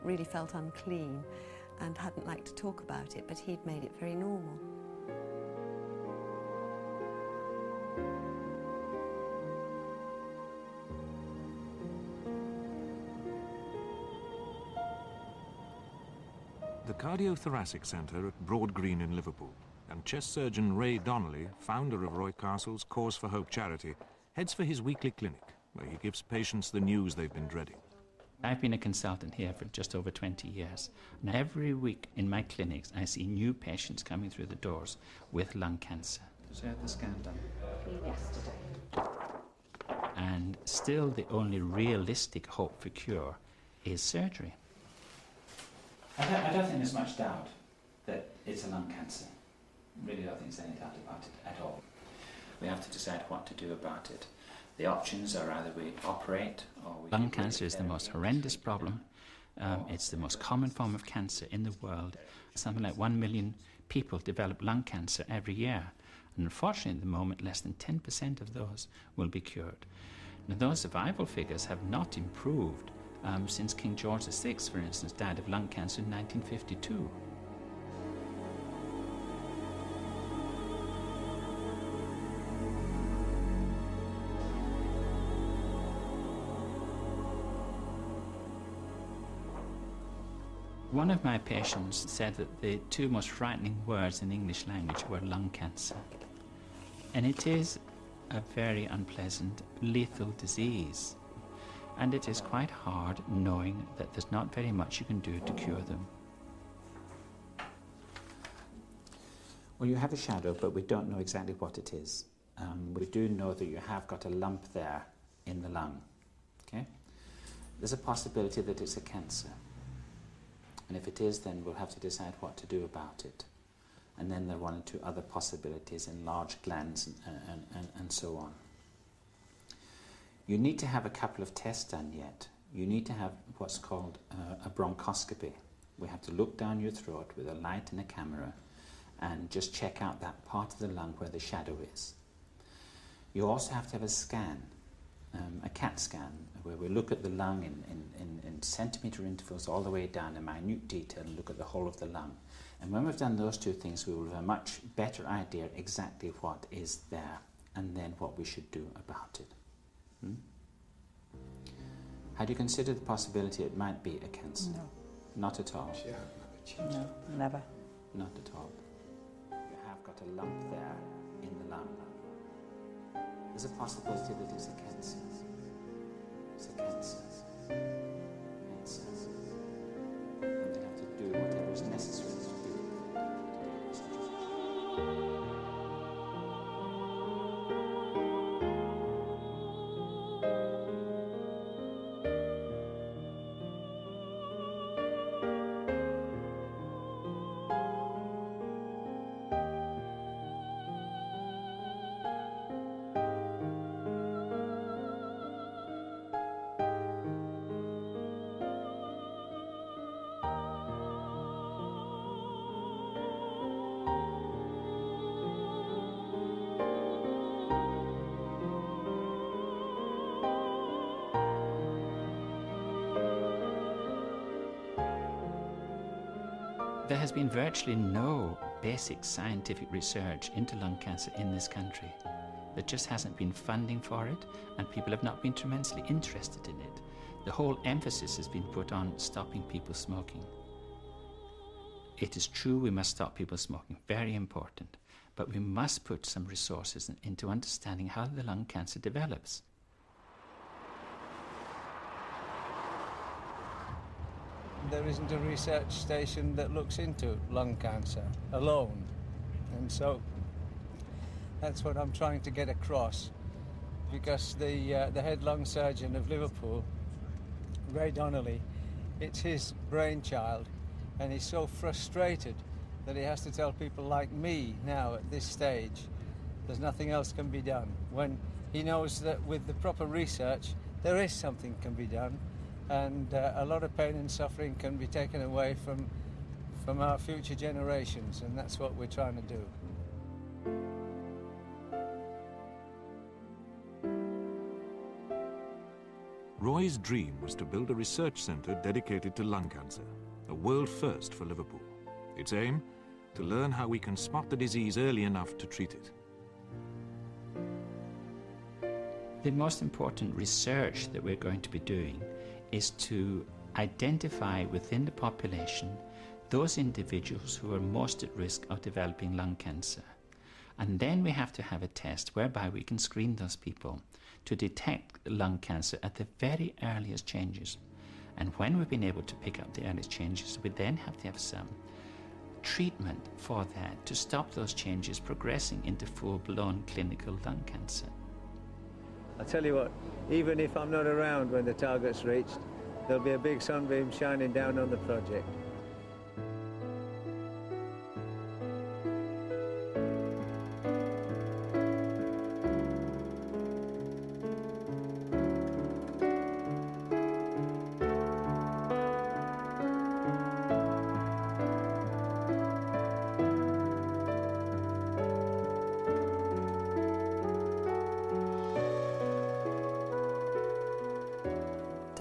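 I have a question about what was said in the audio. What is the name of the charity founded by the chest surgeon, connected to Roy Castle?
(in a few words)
Cause for Hope.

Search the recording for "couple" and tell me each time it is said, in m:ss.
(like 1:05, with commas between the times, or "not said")
2:11.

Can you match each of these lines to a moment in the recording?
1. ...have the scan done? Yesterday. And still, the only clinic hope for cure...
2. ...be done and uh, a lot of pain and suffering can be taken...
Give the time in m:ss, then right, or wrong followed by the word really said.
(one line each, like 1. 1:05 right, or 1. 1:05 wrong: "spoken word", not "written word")
1. 0:36 wrong: "realistic", not "clinic"
2. 4:41 right.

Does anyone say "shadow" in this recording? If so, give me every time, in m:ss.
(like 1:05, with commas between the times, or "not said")
1:50, 2:21.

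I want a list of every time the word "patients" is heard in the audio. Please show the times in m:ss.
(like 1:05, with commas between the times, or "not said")
0:26, 0:33, 1:31.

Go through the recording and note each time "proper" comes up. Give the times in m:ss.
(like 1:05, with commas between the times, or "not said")
4:39.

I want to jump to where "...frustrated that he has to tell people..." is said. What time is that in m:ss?
4:31.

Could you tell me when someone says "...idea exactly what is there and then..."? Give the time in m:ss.
2:35.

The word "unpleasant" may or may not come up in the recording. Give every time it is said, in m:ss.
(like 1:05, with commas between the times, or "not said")
1:38.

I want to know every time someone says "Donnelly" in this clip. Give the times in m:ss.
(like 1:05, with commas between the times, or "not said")
0:20, 4:28.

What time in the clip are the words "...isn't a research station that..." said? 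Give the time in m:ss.
4:15.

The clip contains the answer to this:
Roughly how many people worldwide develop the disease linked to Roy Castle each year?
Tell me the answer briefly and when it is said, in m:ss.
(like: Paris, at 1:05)
1 million, at 1:02.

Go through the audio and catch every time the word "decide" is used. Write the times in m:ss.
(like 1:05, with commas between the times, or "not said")
0:52, 2:01.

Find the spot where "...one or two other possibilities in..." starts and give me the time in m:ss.
2:04.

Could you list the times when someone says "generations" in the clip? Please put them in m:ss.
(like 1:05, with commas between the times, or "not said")
4:47.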